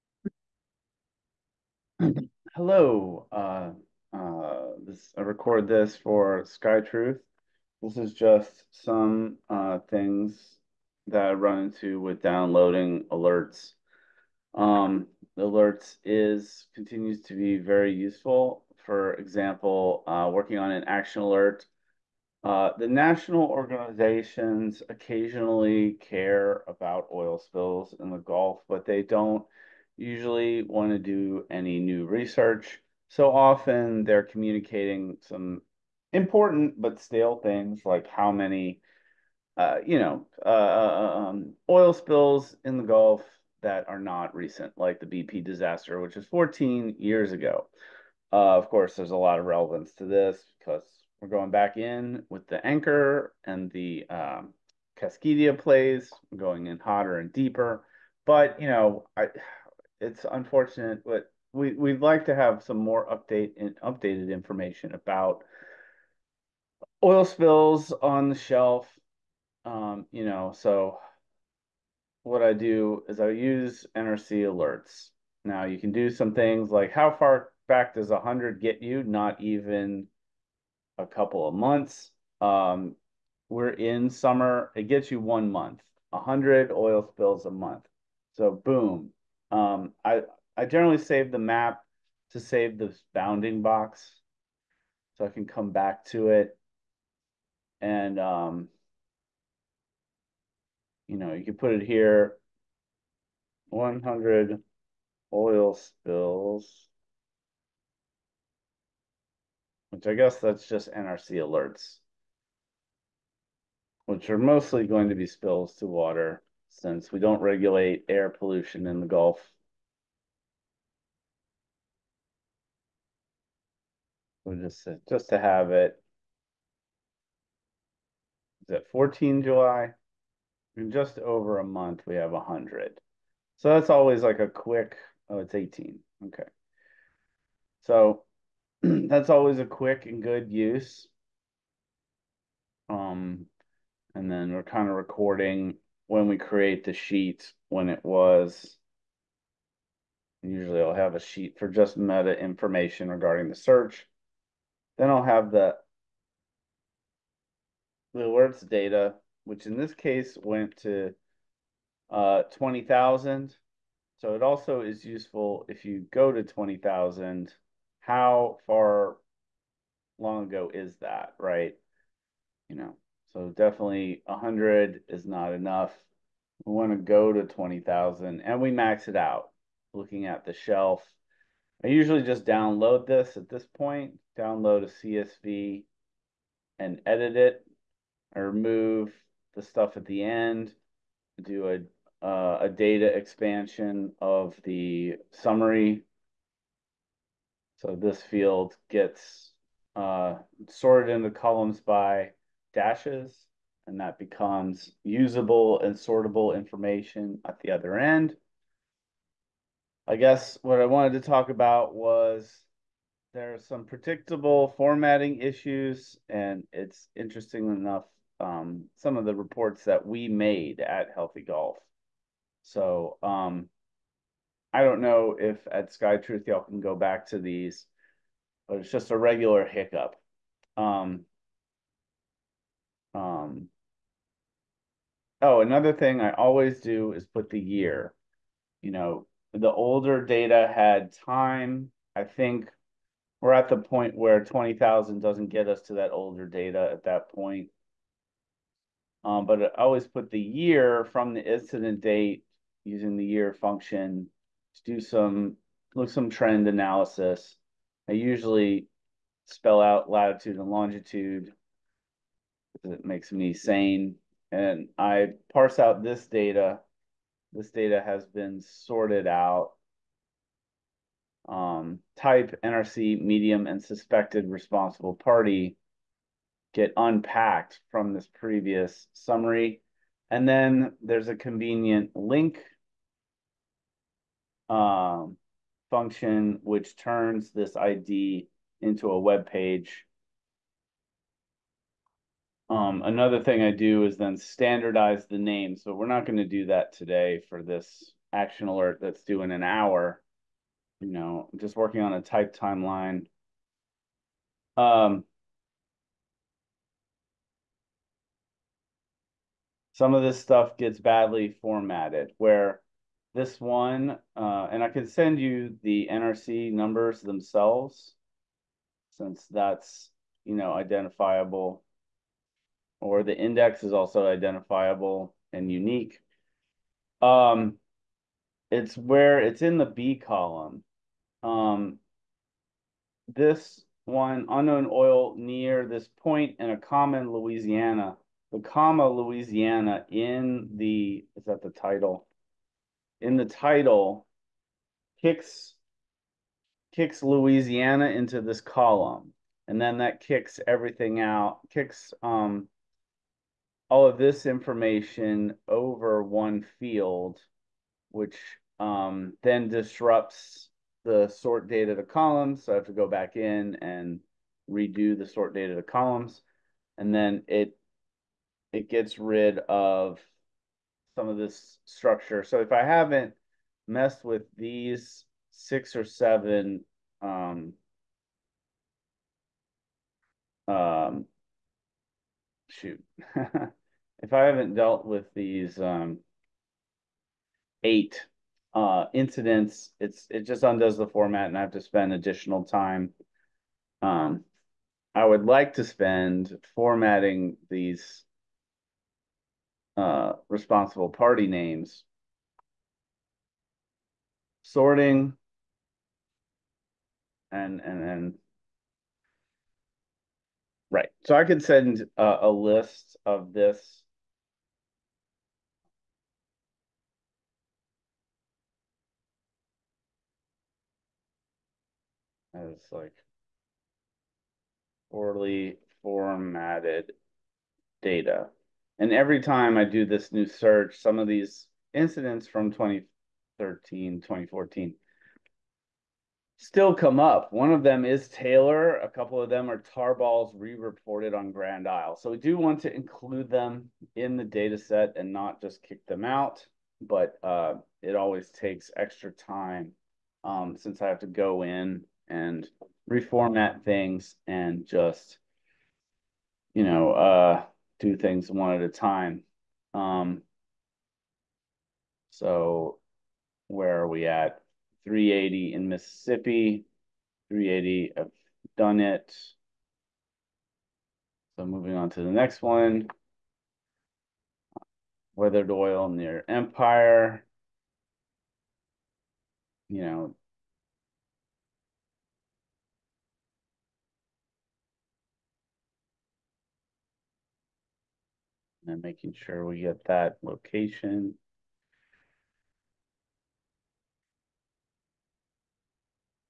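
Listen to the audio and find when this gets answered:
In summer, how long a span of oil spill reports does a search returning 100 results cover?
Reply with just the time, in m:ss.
1:25.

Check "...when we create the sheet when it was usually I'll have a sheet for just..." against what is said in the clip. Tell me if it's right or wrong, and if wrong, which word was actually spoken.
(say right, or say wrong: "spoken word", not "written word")
right.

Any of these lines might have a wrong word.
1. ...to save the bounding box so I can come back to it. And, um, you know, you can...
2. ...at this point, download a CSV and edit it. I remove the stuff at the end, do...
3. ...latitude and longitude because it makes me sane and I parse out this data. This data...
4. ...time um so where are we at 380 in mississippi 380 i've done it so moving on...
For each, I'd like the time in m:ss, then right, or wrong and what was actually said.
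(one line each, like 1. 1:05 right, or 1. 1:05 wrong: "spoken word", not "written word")
1. 1:32 right
2. 3:03 right
3. 4:20 right
4. 7:38 right.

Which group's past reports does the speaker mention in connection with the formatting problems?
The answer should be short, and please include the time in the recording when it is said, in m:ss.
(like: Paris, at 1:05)
Healthy Gulf, at 3:41.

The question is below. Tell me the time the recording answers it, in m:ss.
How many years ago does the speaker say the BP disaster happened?
0:46.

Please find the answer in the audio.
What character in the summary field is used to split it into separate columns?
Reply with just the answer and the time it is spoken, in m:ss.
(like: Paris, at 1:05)
dashes, at 3:22.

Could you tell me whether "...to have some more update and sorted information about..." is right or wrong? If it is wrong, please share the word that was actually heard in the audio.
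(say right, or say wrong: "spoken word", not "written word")
wrong: "updated", not "sorted".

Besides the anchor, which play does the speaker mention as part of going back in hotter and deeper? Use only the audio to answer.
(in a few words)
Kaskida.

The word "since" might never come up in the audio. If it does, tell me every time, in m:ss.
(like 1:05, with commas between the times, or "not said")
1:56, 5:19, 7:30.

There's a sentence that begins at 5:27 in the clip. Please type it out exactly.
Um, it's where it's in the B column.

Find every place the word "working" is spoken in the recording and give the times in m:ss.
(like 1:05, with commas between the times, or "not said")
0:20, 5:01.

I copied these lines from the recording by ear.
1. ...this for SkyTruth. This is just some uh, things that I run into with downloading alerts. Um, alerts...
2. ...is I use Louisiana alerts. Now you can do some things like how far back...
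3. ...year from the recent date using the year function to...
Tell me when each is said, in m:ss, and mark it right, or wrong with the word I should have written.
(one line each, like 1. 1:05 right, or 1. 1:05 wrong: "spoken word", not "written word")
1. 0:05 right
2. 1:13 wrong: "NRC", not "Louisiana"
3. 4:10 wrong: "incident", not "recent".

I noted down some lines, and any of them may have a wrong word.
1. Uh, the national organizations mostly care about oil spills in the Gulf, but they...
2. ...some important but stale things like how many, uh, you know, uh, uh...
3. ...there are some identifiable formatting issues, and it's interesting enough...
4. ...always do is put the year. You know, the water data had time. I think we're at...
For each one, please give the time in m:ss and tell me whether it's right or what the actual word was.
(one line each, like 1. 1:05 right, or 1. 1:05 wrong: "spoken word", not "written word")
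1. 0:22 wrong: "occasionally", not "mostly"
2. 0:35 right
3. 3:33 wrong: "predictable", not "identifiable"
4. 3:56 wrong: "older", not "water".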